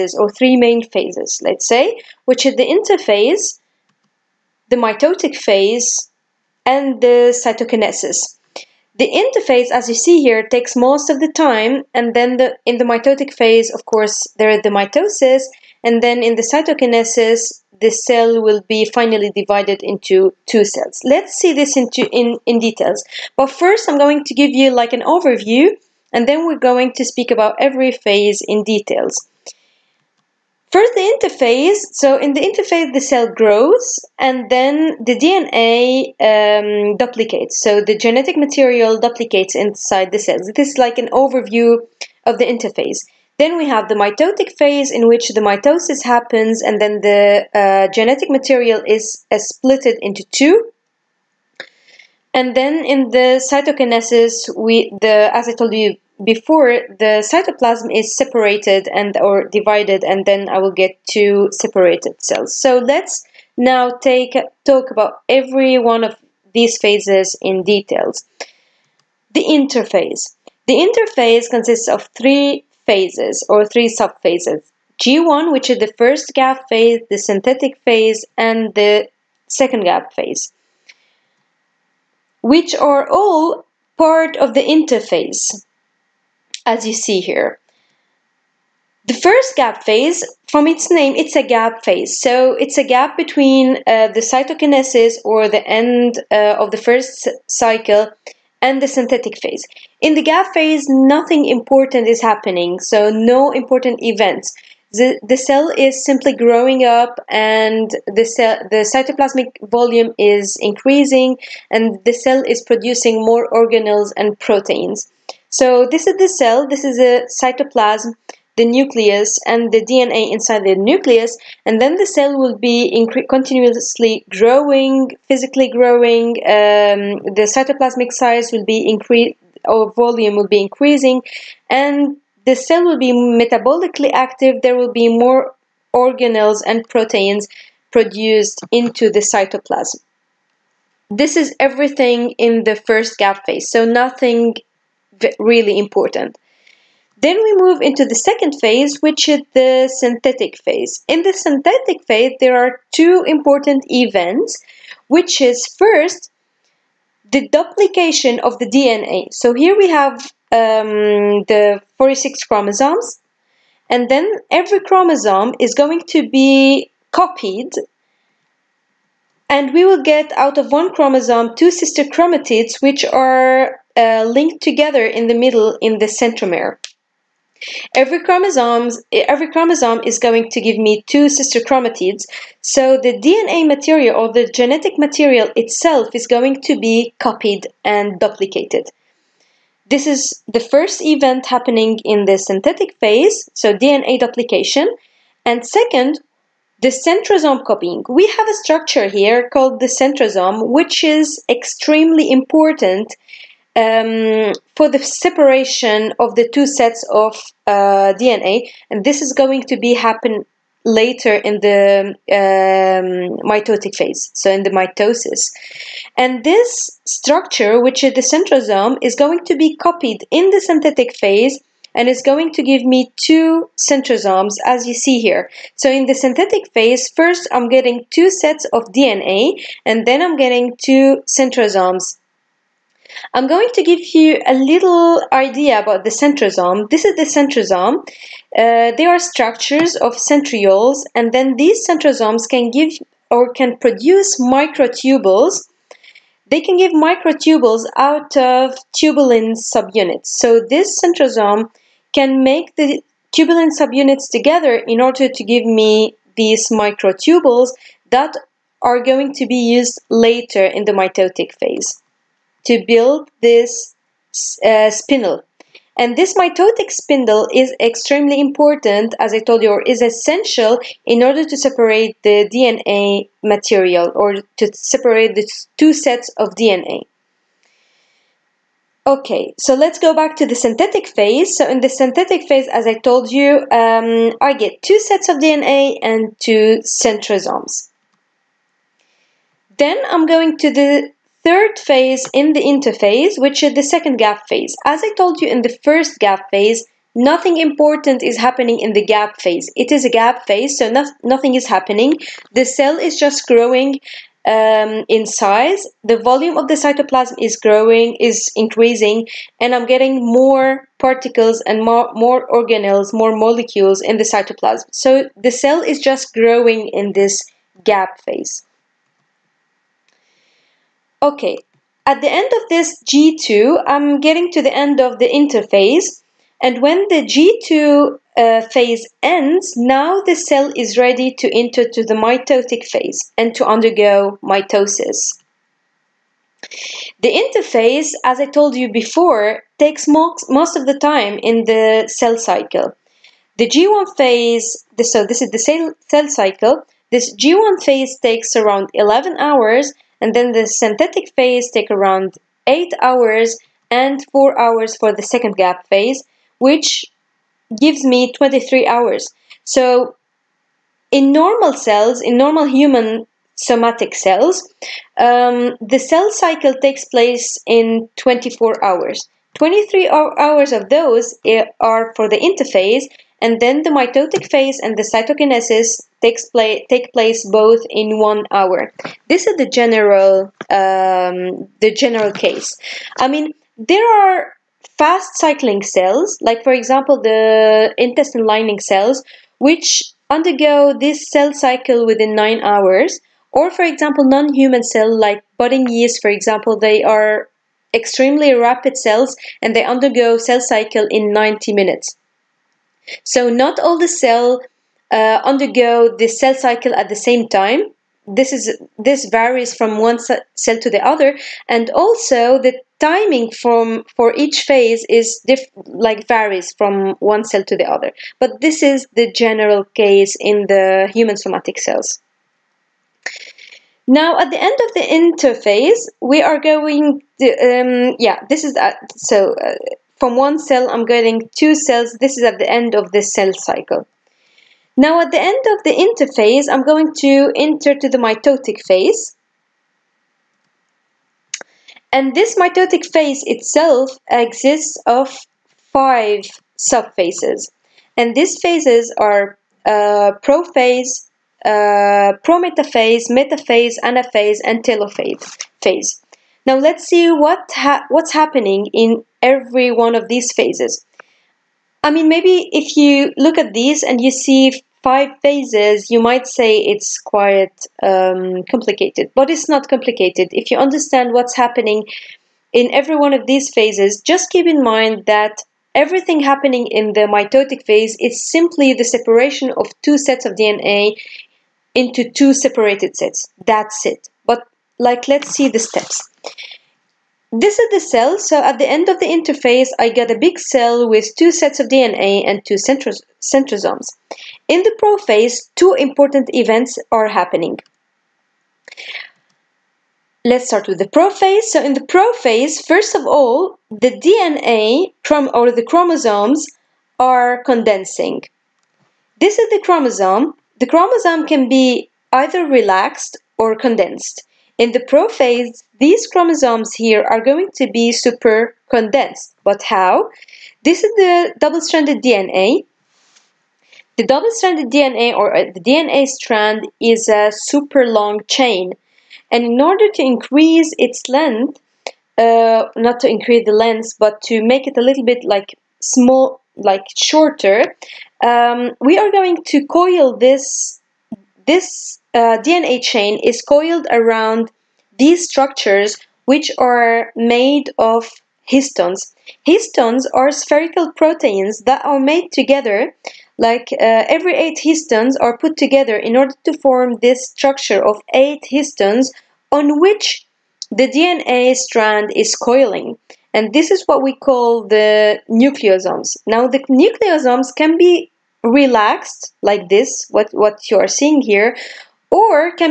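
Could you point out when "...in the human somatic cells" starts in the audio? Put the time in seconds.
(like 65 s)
420 s.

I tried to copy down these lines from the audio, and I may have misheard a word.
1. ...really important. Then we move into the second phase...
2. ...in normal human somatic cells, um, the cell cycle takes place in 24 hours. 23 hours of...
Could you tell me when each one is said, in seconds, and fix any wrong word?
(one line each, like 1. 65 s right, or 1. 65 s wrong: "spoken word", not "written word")
1. 145 s right
2. 362 s right.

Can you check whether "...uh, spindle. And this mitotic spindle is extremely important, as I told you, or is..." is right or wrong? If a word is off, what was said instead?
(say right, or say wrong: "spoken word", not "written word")
right.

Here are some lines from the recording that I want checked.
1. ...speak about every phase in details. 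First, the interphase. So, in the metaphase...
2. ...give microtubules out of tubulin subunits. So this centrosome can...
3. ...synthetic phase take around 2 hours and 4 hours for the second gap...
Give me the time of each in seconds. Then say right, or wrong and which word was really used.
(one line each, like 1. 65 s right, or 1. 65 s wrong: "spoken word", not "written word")
1. 27 s wrong: "interphase", not "metaphase"
2. 246 s right
3. 350 s wrong: "8", not "2".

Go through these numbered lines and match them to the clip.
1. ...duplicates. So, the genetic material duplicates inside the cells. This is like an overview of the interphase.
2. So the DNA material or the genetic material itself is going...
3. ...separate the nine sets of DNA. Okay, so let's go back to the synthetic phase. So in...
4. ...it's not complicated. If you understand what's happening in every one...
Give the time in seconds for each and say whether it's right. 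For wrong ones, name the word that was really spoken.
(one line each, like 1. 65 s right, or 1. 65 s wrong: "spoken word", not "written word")
1. 36 s right
2. 182 s right
3. 274 s wrong: "two", not "nine"
4. 469 s right.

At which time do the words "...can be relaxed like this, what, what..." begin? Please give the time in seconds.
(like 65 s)
567 s.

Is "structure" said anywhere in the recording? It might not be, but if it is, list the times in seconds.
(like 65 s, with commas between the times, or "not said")
198 s, 217 s, 239 s, 545 s, 557 s.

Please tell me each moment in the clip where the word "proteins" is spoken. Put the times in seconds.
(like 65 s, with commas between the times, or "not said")
114 s, 136 s, 551 s.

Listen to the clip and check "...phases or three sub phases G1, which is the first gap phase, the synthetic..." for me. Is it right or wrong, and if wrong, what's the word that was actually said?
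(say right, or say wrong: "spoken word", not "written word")
right.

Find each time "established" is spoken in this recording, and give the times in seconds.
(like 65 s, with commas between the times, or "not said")
not said.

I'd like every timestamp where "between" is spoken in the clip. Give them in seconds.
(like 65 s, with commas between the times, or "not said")
93 s.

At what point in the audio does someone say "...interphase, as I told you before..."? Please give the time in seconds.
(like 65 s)
337 s.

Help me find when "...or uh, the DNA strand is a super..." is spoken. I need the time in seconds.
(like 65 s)
525 s.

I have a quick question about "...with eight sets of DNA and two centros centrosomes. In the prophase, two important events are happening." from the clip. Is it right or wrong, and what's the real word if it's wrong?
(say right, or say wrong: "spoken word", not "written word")
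wrong: "two", not "eight".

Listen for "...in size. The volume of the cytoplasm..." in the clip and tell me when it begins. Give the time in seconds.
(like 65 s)
305 s.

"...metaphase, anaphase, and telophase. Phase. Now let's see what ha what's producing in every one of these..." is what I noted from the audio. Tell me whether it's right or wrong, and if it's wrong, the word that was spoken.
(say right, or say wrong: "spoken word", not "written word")
wrong: "happening", not "producing".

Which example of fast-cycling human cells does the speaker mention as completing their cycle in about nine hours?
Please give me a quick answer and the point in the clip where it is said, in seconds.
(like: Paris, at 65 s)
Intestine lining cells, at 387 s.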